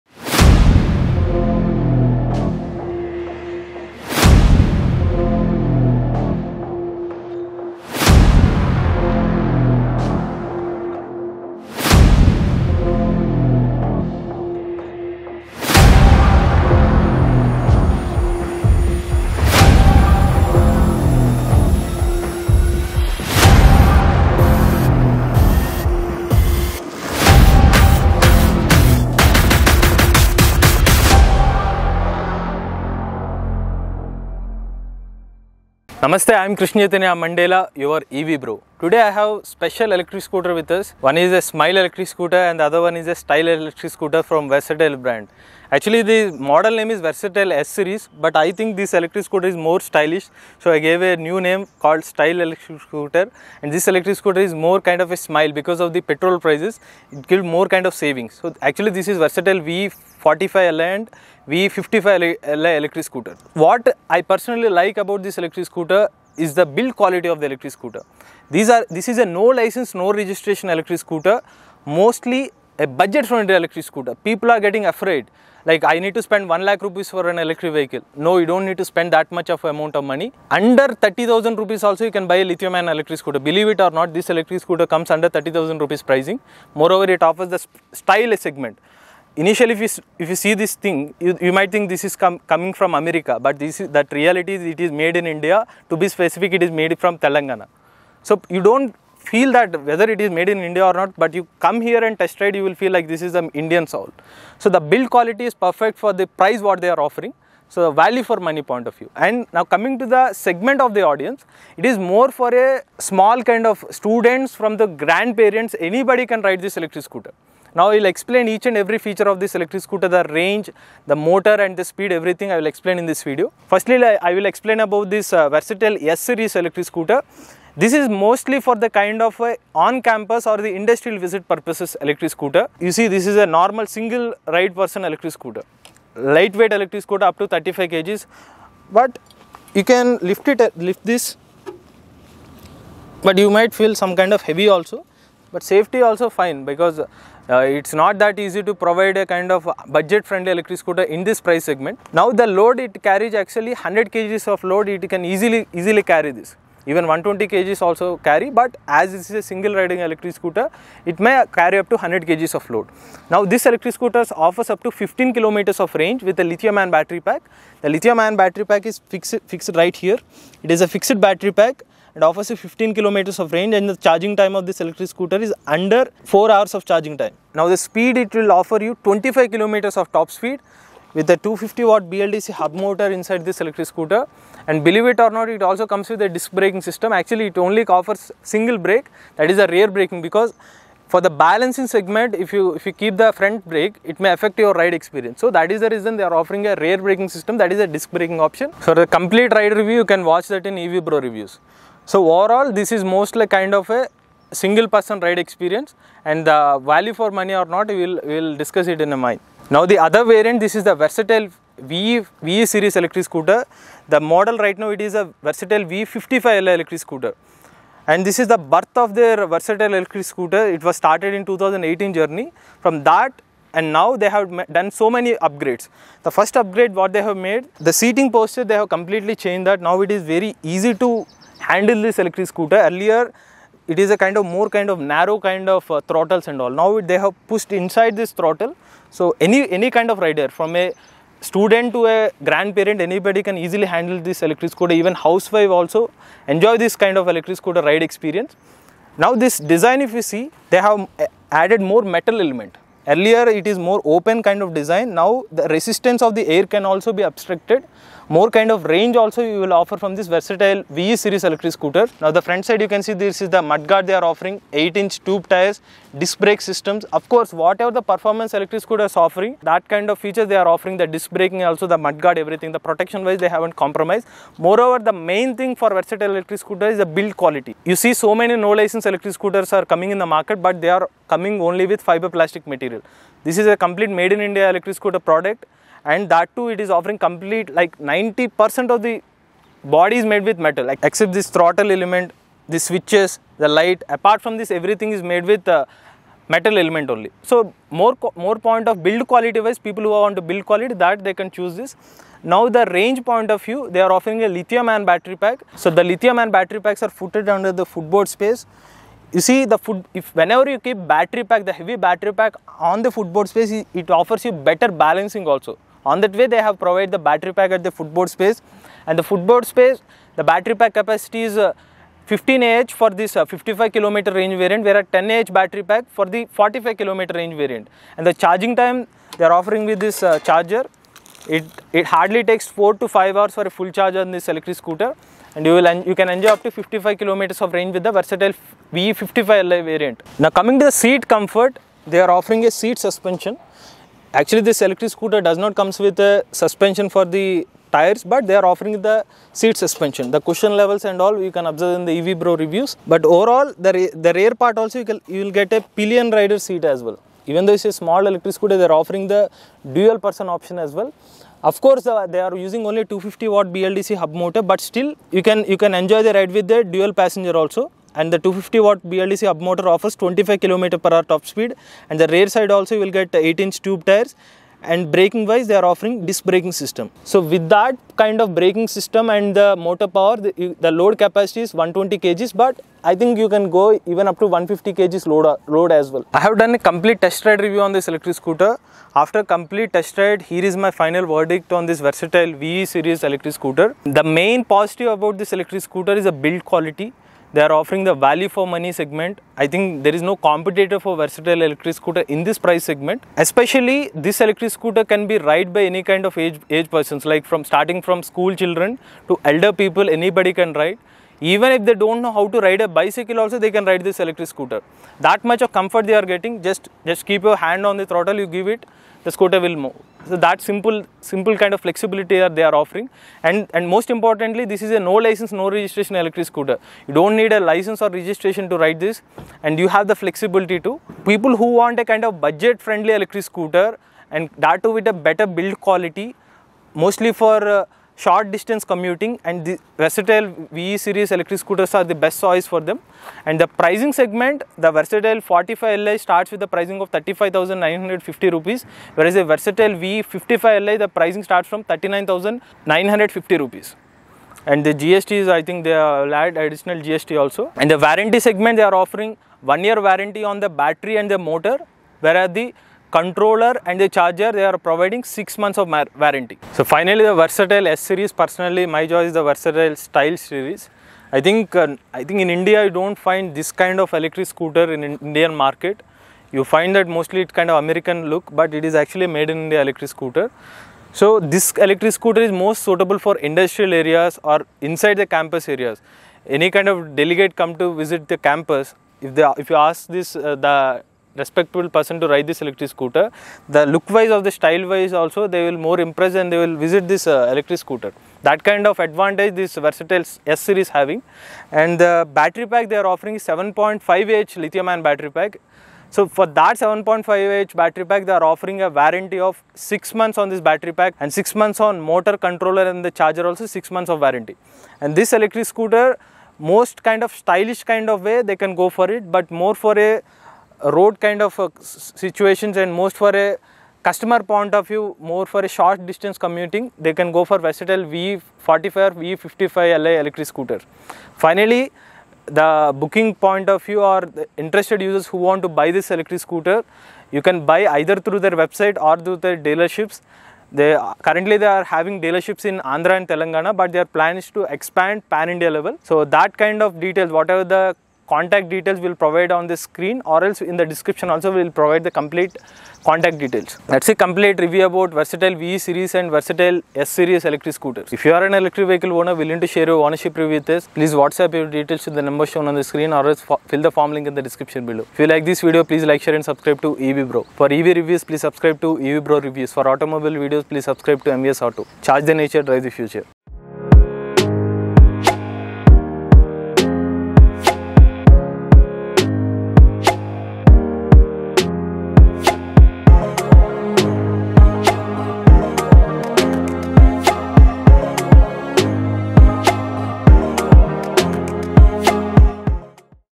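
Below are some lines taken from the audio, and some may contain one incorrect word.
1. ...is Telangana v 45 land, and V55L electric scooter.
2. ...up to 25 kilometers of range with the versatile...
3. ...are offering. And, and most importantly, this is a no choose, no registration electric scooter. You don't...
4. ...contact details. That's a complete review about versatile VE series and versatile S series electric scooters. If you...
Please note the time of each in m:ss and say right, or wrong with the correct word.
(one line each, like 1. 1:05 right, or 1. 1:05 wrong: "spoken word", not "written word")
1. 0:59 wrong: "Versatile", not "Telangana"
2. 5:36 wrong: "55", not "25"
3. 7:02 wrong: "license", not "choose"
4. 9:13 right.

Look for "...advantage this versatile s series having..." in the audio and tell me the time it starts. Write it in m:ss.
8:19.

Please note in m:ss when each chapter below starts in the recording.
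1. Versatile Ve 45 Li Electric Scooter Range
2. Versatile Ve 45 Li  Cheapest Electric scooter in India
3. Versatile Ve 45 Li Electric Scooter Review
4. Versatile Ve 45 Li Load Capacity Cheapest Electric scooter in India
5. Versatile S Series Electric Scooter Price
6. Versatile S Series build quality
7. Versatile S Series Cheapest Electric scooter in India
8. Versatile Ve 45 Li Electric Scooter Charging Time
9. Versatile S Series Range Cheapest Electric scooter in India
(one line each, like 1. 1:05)
1. 4:45
2. 3:00
3. 0:25
4. 4:00
5. 6:25
6. 2:15
7. 1:15
8. 5:45
9. 2:45.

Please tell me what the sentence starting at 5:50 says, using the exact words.
The cushion levels and all you can observe in the EV Bro reviews.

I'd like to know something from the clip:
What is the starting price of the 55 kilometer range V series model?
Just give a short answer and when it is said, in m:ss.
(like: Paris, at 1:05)
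39,950 rupees, at 7:31.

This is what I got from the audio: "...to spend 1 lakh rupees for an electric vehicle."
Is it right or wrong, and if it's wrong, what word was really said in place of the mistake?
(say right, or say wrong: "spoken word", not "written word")
right.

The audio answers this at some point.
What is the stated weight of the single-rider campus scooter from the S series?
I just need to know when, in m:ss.
2:17.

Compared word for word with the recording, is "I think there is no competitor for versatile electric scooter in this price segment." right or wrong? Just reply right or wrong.
right.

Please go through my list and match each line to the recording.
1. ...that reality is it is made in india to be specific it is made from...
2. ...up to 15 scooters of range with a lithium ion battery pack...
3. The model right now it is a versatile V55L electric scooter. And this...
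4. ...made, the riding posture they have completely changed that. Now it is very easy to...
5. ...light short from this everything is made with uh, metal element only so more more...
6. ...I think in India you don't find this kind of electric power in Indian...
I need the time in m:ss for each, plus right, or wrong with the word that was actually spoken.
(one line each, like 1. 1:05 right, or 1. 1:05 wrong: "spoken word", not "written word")
1. 1:33 right
2. 2:44 wrong: "kilometers", not "scooters"
3. 3:34 right
4. 3:47 wrong: "seating", not "riding"
5. 4:53 wrong: "apart", not "short"
6. 7:52 wrong: "scooter", not "power".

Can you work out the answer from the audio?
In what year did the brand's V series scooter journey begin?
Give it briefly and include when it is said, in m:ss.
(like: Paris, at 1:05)
2018, at 3:41.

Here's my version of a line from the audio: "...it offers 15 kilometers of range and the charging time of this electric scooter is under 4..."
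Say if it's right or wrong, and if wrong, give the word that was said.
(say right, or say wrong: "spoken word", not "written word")
right.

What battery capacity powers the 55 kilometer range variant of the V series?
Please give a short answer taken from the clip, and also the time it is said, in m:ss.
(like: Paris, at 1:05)
15 Ah, at 5:22.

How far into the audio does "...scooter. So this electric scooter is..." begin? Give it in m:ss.
8:00.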